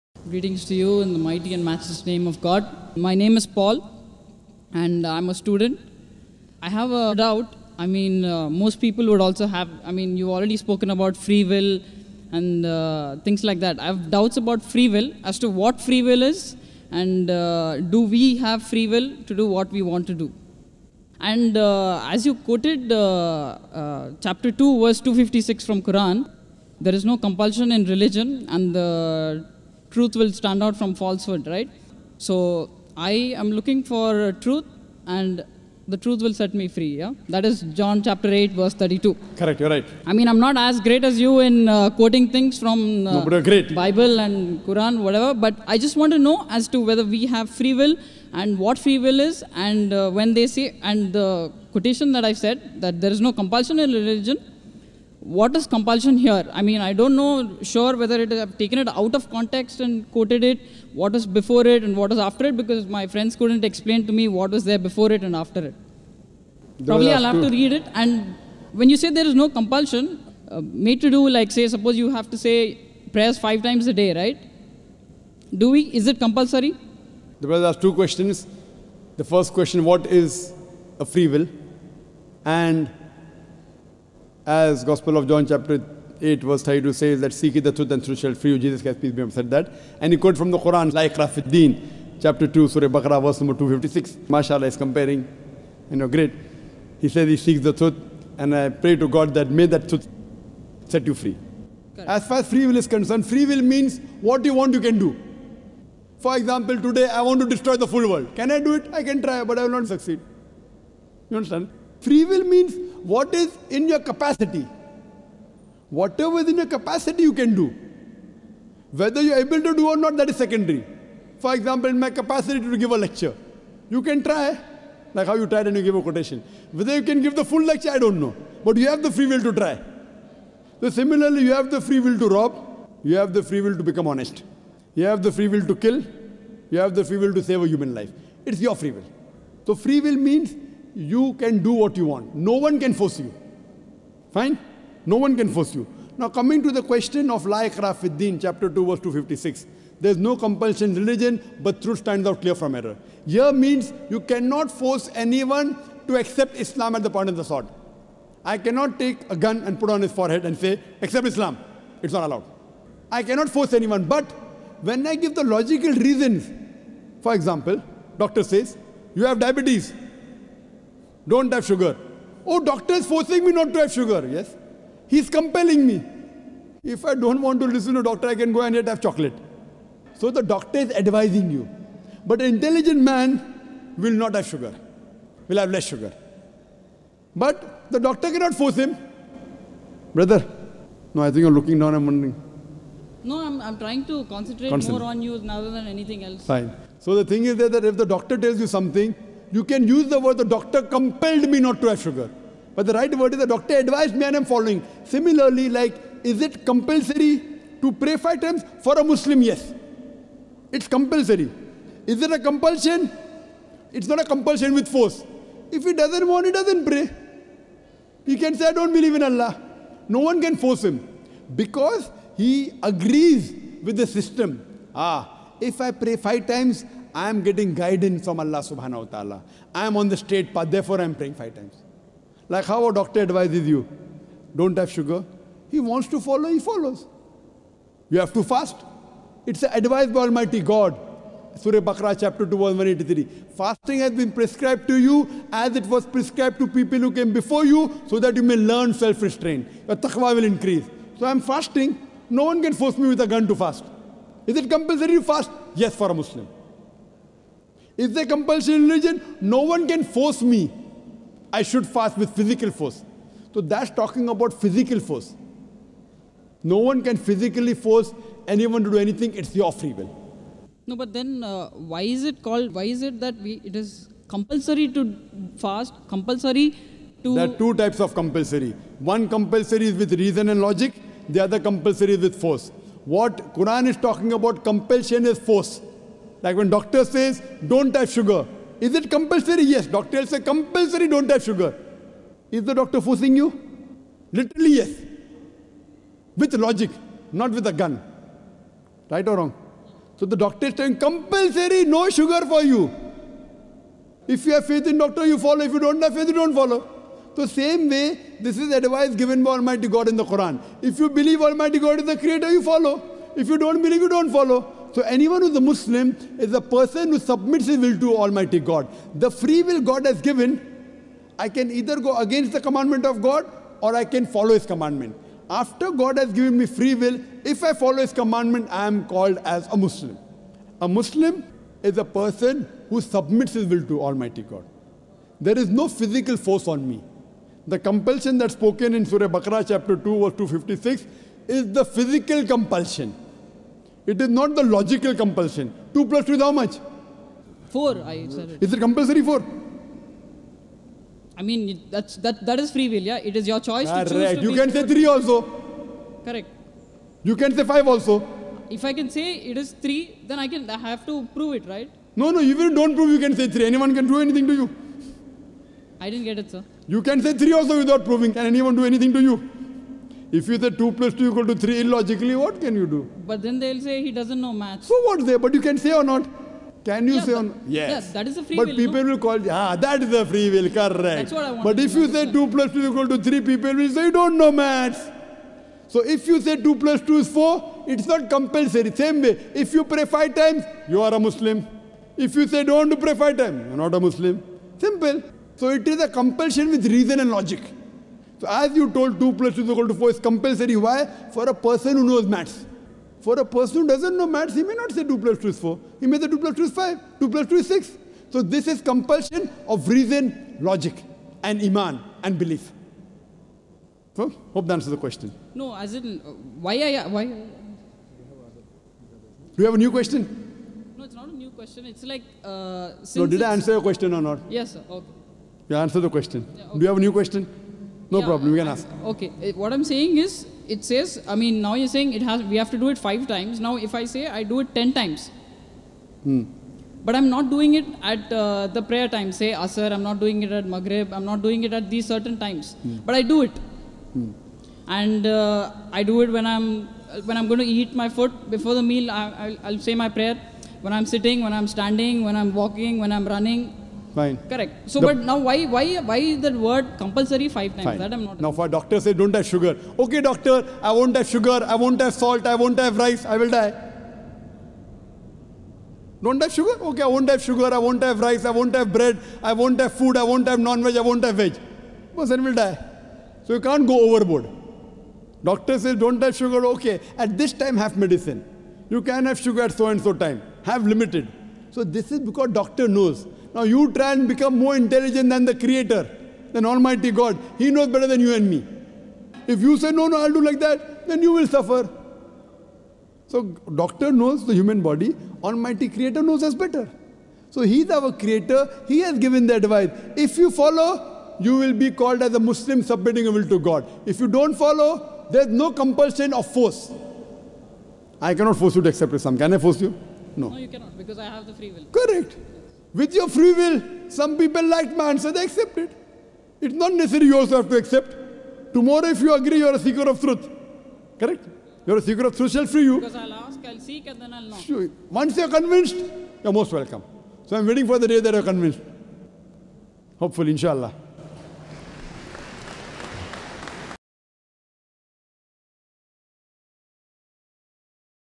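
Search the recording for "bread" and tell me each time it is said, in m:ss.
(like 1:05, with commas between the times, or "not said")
7:48.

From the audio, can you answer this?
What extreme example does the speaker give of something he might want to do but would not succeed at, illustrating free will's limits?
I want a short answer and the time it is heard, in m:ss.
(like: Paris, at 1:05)
destroy the full world, at 1:47.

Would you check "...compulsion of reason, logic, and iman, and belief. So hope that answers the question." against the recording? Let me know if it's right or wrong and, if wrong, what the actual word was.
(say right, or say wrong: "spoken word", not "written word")
right.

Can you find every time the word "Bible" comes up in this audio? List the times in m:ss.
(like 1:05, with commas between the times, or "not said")
0:43.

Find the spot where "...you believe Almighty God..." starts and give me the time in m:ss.
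5:10.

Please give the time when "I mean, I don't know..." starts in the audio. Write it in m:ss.
0:56.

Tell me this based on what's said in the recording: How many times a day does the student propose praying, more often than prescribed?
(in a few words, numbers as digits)
10.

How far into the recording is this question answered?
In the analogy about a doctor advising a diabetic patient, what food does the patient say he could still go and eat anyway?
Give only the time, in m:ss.
2:59.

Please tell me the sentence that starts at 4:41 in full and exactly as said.
The other compulsory is with force.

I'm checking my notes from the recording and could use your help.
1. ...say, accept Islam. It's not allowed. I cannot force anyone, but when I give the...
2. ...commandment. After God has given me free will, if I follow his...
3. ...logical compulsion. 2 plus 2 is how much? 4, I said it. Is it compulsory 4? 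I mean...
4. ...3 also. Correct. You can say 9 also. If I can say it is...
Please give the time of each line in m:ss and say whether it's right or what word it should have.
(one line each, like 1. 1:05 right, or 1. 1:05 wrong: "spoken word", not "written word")
1. 2:40 right
2. 5:24 right
3. 5:44 right
4. 5:54 wrong: "5", not "9".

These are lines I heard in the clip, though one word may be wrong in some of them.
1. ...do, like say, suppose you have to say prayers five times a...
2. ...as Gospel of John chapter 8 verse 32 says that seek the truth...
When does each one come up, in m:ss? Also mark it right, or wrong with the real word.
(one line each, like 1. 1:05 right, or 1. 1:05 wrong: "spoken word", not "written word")
1. 1:11 right
2. 1:24 right.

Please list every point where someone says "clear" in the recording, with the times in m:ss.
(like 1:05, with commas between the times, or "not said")
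2:32.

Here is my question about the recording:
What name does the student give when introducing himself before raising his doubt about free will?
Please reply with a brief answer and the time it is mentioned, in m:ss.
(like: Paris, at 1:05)
Paul, at 0:03.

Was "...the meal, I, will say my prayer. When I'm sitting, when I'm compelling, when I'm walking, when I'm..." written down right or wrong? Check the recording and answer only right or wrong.
wrong.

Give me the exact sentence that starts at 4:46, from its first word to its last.
Like when doctor says, don't have sugar.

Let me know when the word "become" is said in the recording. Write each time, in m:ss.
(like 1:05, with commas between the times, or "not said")
2:13, 8:04.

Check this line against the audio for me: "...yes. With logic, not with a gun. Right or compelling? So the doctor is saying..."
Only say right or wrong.
wrong.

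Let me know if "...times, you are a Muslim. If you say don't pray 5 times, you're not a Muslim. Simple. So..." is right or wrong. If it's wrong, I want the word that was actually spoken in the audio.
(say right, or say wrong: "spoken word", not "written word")
right.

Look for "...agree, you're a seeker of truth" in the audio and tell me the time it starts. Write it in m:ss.
8:39.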